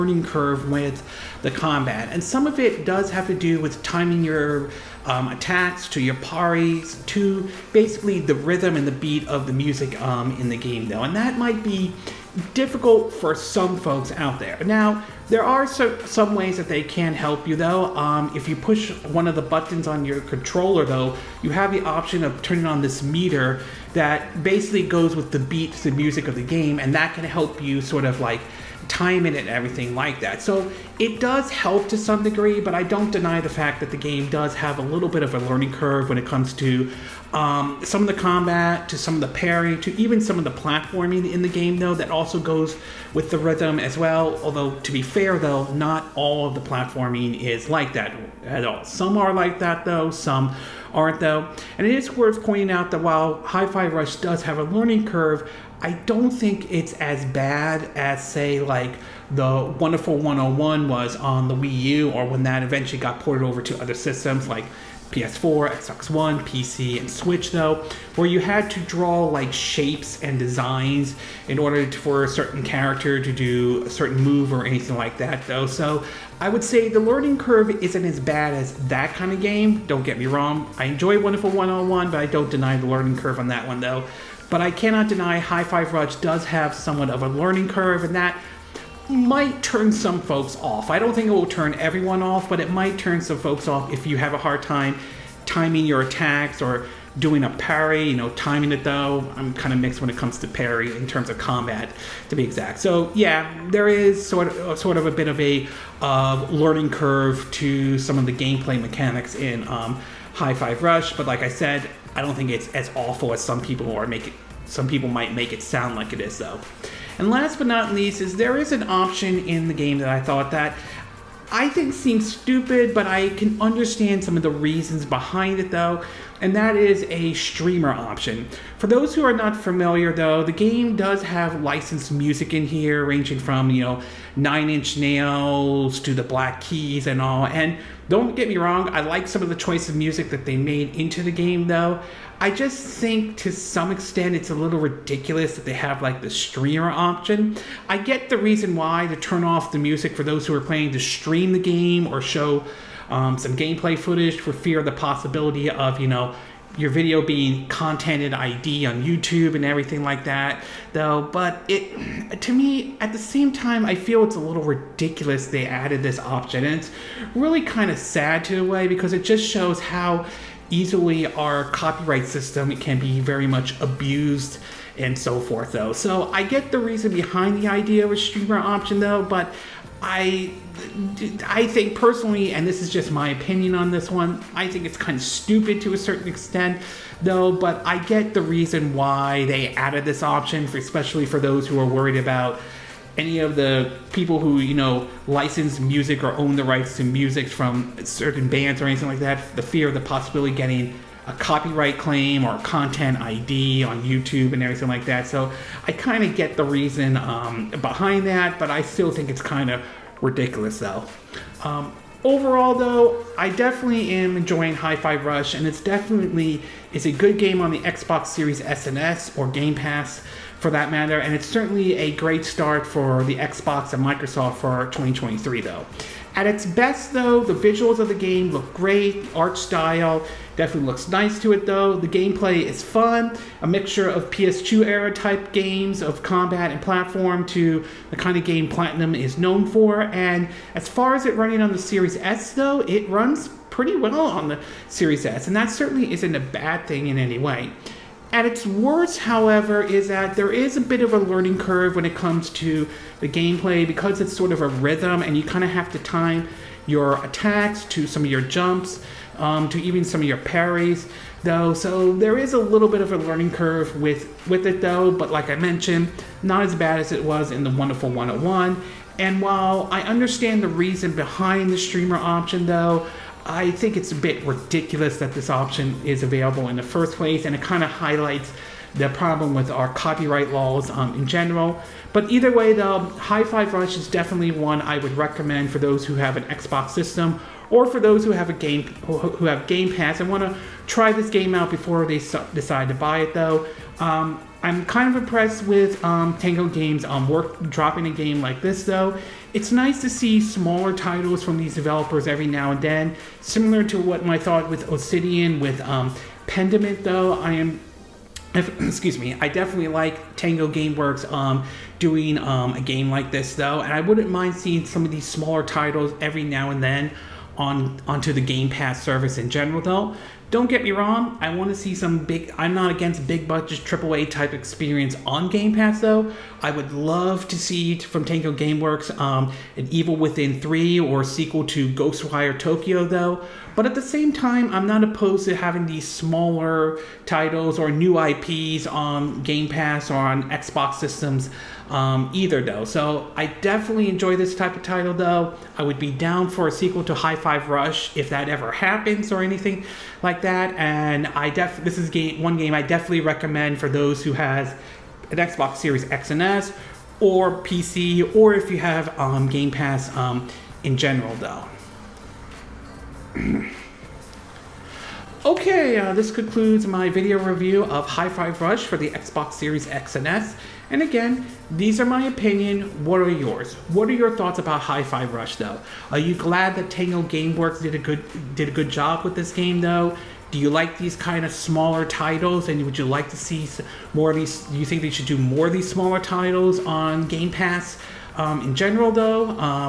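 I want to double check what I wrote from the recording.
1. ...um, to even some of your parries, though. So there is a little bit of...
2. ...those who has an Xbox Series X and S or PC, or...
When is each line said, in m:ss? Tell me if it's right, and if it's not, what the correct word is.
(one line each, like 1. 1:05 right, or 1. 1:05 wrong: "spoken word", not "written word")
1. 4:19 right
2. 5:53 right.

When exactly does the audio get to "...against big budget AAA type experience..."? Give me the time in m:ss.
5:22.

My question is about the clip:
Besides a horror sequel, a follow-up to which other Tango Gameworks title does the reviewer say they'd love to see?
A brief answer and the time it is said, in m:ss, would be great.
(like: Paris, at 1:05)
Ghostwire Tokyo, at 5:31.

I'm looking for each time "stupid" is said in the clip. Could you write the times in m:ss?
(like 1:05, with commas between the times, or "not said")
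2:02, 3:05.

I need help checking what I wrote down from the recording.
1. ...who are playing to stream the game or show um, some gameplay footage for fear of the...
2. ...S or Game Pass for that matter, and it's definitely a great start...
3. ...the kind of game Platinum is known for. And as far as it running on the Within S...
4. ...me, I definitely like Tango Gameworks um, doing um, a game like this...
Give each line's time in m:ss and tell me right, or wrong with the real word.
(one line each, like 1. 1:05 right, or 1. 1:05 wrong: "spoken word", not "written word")
1. 2:30 right
2. 3:38 wrong: "certainly", not "definitely"
3. 3:58 wrong: "Series", not "Within"
4. 5:09 right.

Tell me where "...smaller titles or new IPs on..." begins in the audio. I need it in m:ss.
5:36.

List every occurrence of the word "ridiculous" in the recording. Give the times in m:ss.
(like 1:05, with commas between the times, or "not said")
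2:24, 2:44, 3:30, 4:34.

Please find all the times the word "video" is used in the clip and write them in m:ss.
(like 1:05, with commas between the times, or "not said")
2:36, 6:07.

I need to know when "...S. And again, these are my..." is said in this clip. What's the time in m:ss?
6:10.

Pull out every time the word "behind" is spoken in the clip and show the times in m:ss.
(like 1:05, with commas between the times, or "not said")
2:05, 2:57, 3:27, 4:31.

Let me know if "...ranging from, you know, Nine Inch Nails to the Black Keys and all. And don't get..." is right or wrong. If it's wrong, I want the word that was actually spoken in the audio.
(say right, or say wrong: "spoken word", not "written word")
right.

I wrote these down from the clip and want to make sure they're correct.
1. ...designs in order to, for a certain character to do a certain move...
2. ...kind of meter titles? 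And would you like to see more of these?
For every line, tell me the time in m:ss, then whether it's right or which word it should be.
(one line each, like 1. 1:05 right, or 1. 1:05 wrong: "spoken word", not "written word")
1. 1:10 right
2. 6:21 wrong: "smaller", not "meter".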